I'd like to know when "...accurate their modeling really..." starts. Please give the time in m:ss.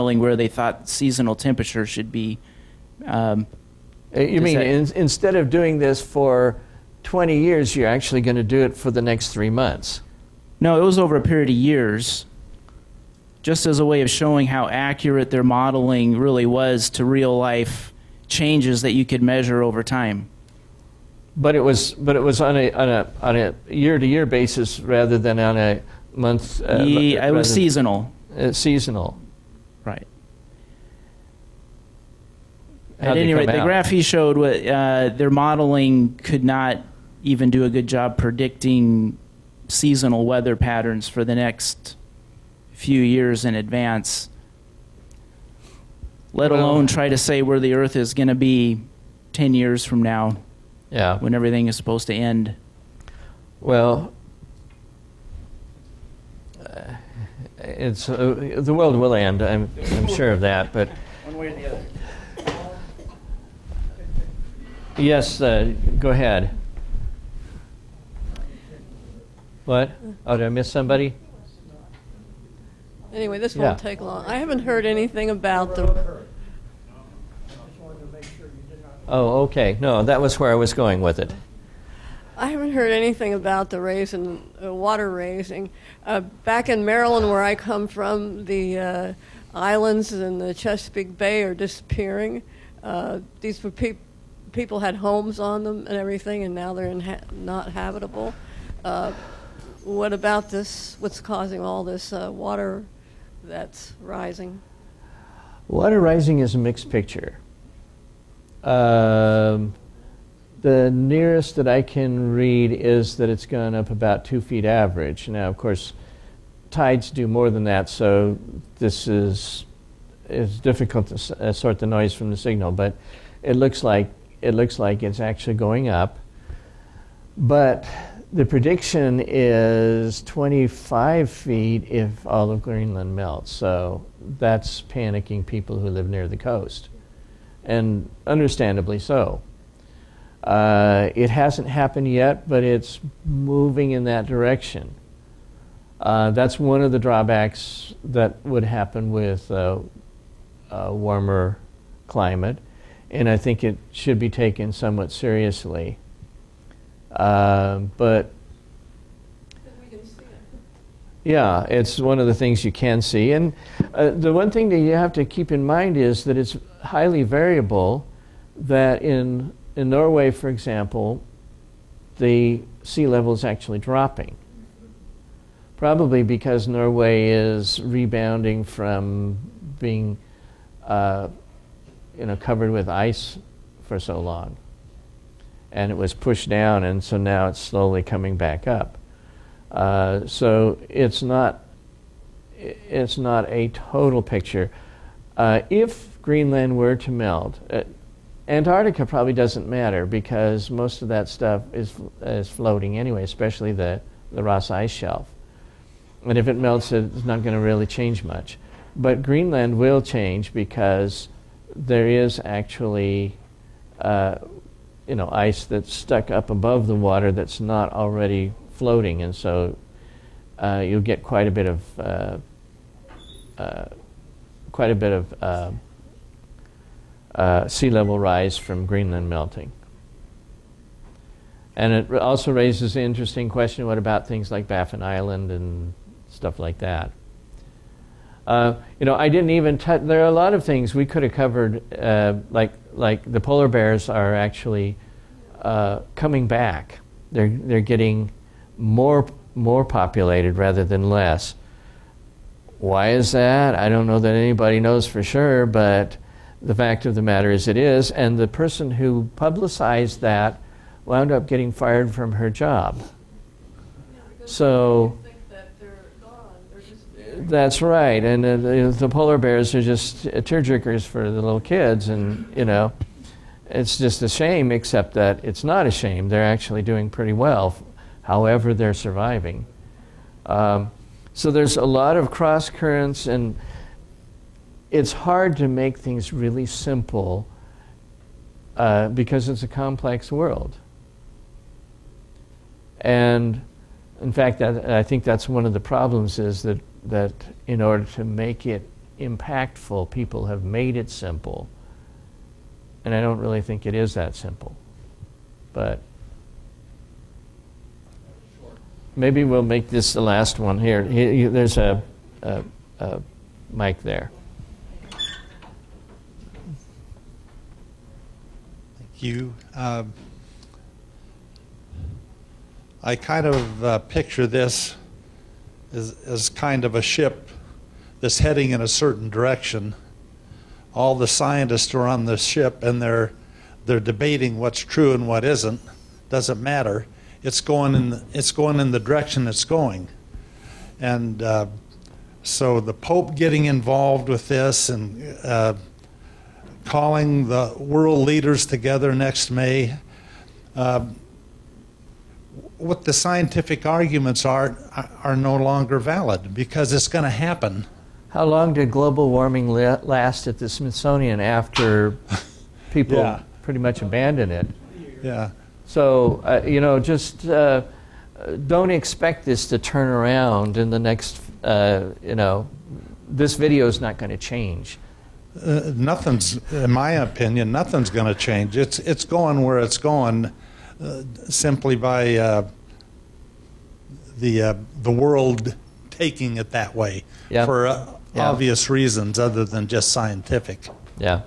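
0:14.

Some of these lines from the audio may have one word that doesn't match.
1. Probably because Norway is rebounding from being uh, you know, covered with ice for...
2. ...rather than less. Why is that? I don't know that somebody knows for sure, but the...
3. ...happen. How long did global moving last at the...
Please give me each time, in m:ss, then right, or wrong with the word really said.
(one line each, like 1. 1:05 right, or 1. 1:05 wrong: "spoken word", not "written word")
1. 2:55 right
2. 4:10 wrong: "anybody", not "somebody"
3. 5:57 wrong: "warming", not "moving".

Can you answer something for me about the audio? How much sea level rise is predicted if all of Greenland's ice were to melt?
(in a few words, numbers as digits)
25 feet.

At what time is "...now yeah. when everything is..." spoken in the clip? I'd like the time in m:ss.
0:50.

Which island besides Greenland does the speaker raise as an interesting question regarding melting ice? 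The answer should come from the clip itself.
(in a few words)
Baffin Island.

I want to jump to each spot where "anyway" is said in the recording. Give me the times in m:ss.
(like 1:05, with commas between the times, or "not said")
1:13, 3:22.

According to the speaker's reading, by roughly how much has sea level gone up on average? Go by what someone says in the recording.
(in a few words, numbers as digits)
2 feet.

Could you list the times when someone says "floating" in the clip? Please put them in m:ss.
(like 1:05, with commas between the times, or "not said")
3:22, 3:38.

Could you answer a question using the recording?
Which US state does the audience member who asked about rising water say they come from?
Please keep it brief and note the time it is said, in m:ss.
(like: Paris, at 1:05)
Maryland, at 1:26.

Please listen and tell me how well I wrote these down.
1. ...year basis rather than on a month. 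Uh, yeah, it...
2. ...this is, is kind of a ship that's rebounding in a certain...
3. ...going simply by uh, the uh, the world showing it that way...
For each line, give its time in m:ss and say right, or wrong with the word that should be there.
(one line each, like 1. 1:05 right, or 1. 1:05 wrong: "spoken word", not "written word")
1. 0:24 right
2. 5:24 wrong: "heading", not "rebounding"
3. 6:19 wrong: "taking", not "showing".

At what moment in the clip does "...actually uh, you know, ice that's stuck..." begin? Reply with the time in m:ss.
3:32.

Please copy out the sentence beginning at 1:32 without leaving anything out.
Uh, these were pe- people had homes on them and everything, and now they're not habitable.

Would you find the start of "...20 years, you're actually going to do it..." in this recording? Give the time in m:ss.
0:07.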